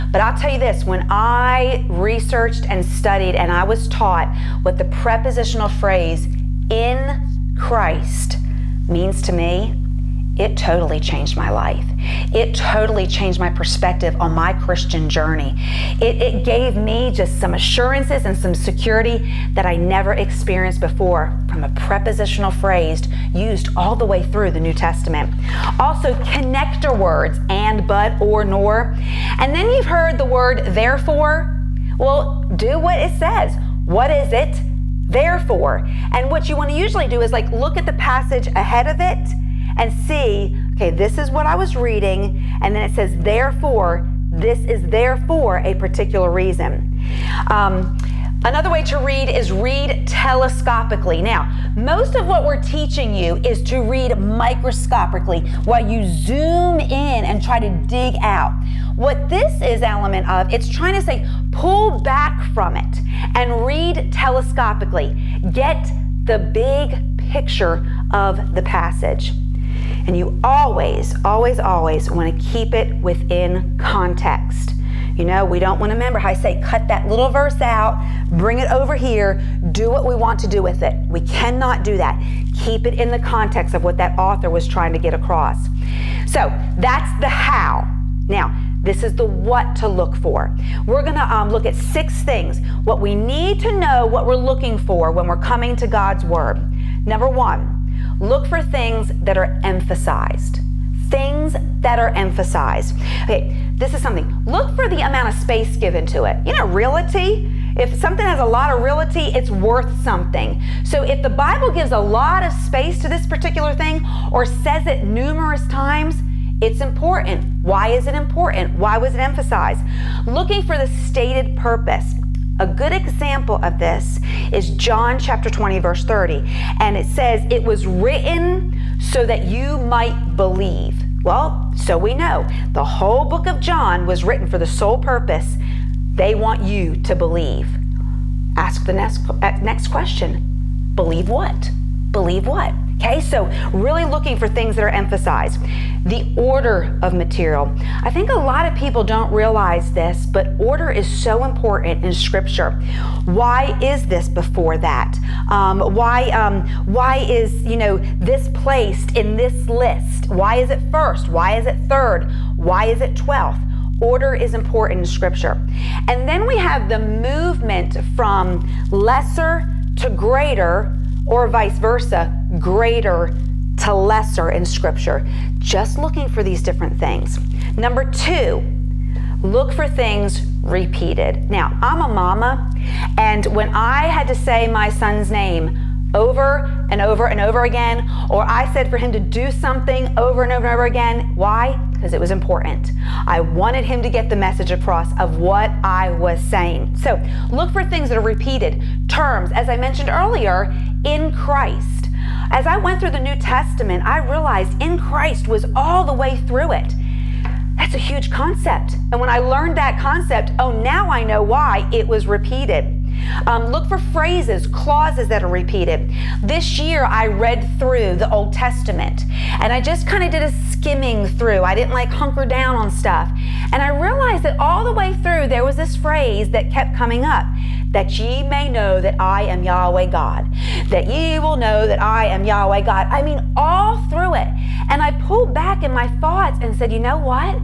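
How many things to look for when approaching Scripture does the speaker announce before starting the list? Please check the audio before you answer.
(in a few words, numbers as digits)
6.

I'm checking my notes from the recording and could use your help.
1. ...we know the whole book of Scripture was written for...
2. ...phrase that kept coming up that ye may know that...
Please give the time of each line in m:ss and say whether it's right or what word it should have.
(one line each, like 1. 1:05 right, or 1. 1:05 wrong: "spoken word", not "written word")
1. 2:11 wrong: "John", not "Scripture"
2. 3:45 right.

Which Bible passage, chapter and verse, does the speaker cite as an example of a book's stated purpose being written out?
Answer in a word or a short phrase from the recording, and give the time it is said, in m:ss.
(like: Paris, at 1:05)
John 20:30, at 2:04.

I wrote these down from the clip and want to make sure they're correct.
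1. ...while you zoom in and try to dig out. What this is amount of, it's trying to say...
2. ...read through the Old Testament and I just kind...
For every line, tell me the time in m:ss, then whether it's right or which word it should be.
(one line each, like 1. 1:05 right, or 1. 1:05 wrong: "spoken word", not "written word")
1. 0:55 wrong: "element", not "amount"
2. 3:37 right.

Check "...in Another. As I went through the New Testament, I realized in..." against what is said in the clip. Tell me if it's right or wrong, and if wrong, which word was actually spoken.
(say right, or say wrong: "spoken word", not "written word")
wrong: "Christ", not "Another".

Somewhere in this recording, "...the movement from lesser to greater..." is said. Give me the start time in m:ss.
2:46.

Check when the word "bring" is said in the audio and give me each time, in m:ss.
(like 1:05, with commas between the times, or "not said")
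1:18.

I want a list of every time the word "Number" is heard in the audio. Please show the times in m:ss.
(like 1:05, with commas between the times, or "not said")
1:37, 2:57.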